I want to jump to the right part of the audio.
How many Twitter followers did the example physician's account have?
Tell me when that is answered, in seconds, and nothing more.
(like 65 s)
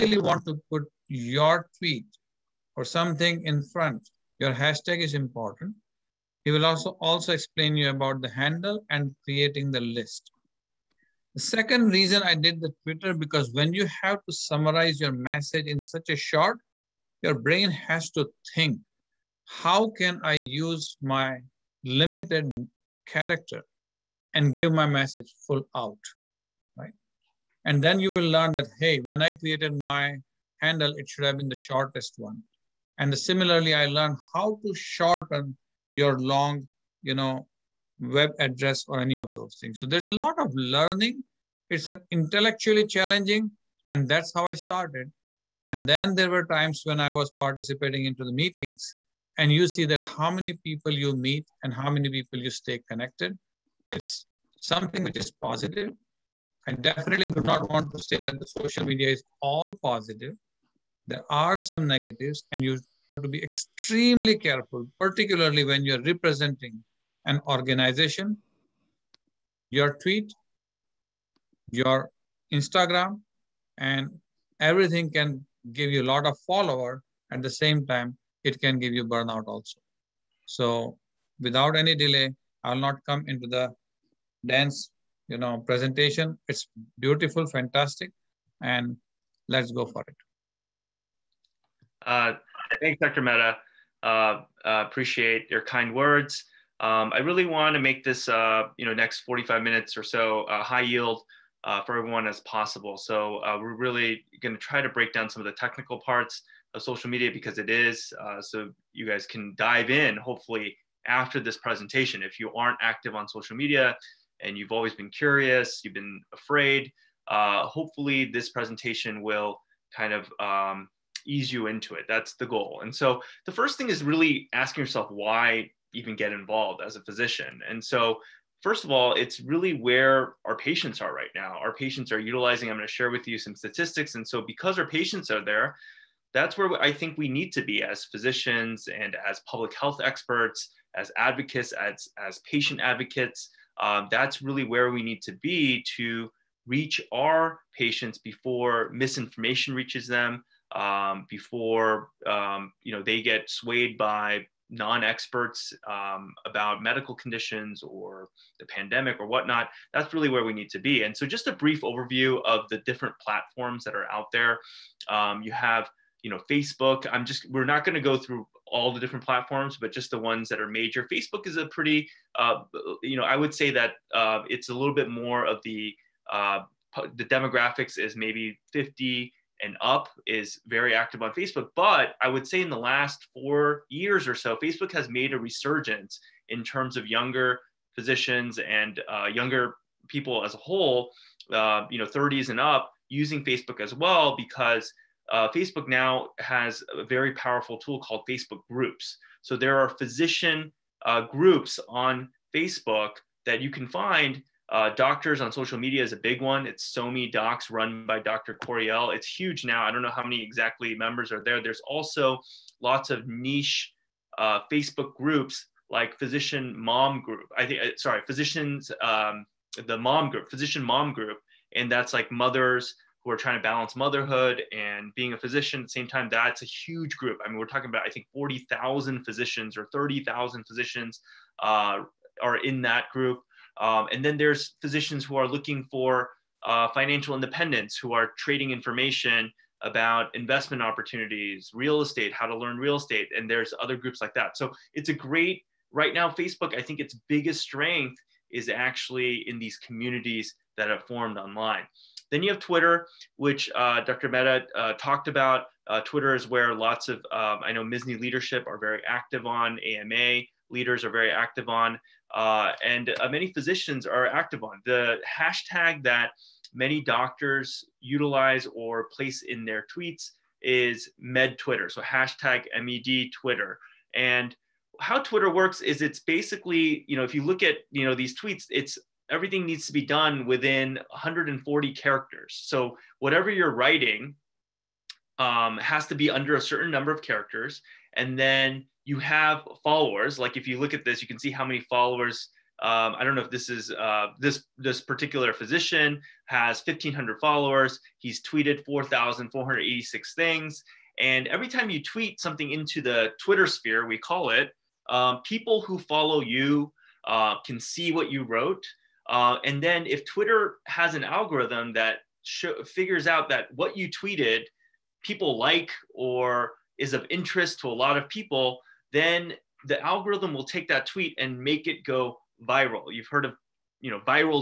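296 s.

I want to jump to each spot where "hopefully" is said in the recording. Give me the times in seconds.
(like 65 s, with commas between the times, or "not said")
110 s, 117 s.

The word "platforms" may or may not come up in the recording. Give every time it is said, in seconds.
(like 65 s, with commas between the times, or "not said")
163 s, 169 s.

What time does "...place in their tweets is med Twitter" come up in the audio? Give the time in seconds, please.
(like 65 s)
269 s.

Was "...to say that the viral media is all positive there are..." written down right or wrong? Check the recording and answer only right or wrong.
wrong.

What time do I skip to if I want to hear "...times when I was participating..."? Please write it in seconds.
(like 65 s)
46 s.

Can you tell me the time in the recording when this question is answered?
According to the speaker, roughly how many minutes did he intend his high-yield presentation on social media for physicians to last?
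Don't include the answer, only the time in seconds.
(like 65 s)
99 s.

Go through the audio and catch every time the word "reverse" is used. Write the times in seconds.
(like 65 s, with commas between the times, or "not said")
not said.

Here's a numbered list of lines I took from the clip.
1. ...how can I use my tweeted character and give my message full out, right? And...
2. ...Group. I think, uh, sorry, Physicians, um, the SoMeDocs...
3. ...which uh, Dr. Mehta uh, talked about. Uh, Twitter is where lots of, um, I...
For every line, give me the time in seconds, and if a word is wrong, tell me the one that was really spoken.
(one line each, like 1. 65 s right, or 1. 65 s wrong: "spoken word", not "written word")
1. 19 s wrong: "limited", not "tweeted"
2. 217 s wrong: "Mom", not "SoMeDocs"
3. 253 s right.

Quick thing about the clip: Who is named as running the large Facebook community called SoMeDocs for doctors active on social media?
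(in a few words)
Dr. Coriel.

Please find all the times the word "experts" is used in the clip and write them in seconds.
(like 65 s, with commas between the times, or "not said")
140 s, 154 s.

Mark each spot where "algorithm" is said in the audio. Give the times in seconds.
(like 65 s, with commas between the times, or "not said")
311 s, 320 s.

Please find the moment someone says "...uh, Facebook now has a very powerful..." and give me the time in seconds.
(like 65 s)
195 s.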